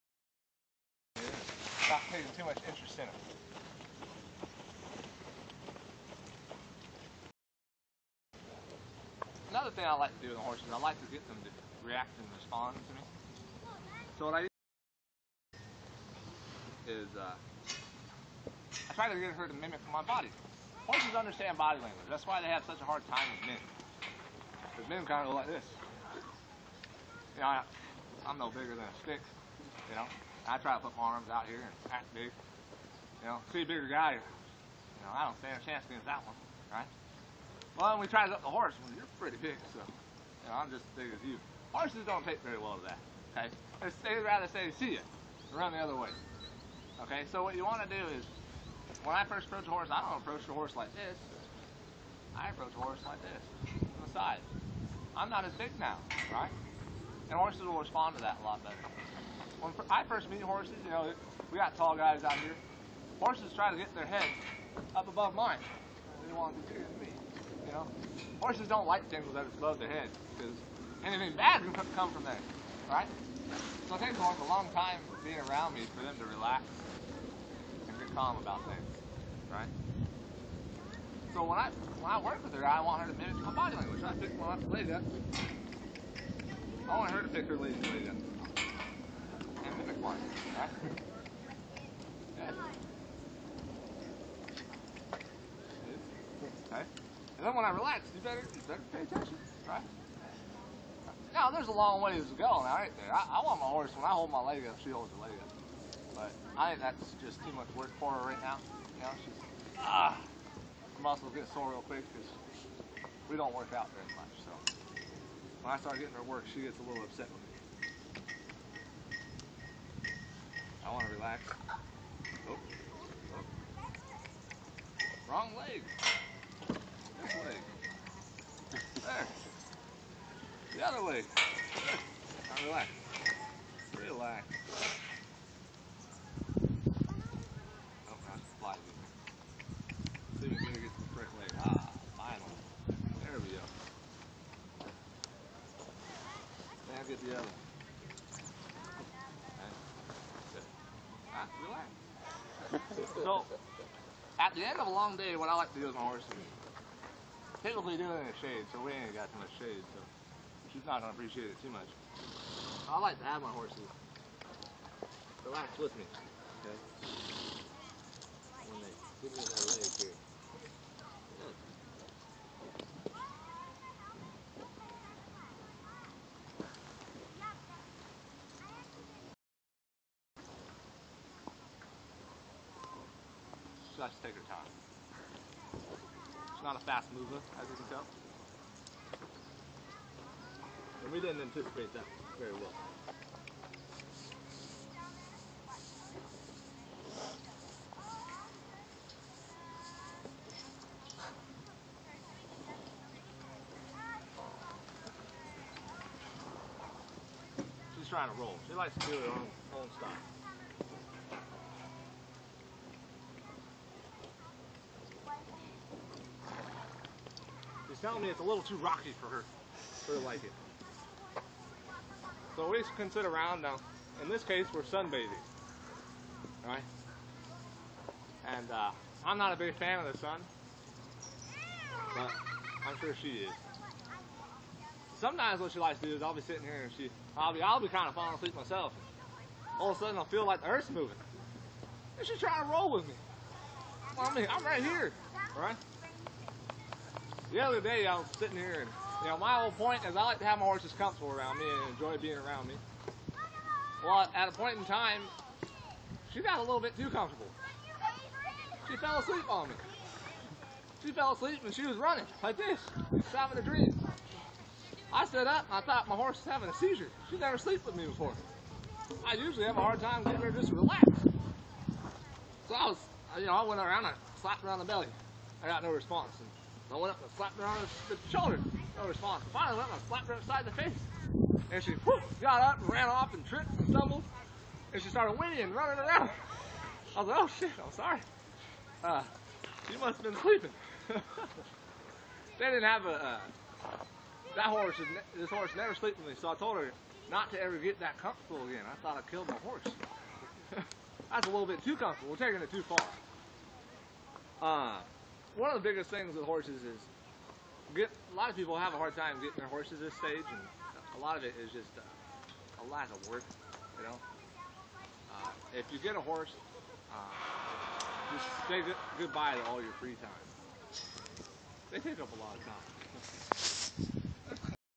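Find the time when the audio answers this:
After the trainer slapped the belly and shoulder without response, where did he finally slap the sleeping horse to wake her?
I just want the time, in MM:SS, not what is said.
04:40.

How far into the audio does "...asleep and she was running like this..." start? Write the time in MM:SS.
04:21.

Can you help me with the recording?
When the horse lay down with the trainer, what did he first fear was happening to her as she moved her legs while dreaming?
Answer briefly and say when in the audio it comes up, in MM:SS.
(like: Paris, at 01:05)
a seizure, at 04:26.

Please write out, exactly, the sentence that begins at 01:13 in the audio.
So it takes a long time being around me for them to relax and get calm about things, right?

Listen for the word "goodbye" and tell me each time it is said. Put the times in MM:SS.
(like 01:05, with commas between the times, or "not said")
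05:19.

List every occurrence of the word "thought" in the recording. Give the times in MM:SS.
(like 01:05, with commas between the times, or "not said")
04:25, 04:59.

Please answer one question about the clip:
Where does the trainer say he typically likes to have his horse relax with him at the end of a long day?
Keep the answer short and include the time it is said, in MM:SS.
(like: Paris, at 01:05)
in the shade, at 02:38.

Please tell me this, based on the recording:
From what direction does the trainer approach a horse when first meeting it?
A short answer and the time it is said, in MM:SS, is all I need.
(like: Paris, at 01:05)
on the side, at 00:53.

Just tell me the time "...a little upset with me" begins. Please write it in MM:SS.
01:56.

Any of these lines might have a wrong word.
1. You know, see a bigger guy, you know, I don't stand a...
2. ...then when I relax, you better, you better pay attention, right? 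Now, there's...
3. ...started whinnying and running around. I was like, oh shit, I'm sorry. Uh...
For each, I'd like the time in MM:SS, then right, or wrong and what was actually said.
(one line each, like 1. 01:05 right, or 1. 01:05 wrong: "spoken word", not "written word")
1. 00:33 right
2. 01:37 right
3. 04:45 right.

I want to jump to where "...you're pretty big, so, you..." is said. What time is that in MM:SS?
00:38.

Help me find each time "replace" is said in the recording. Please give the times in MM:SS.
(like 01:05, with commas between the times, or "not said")
not said.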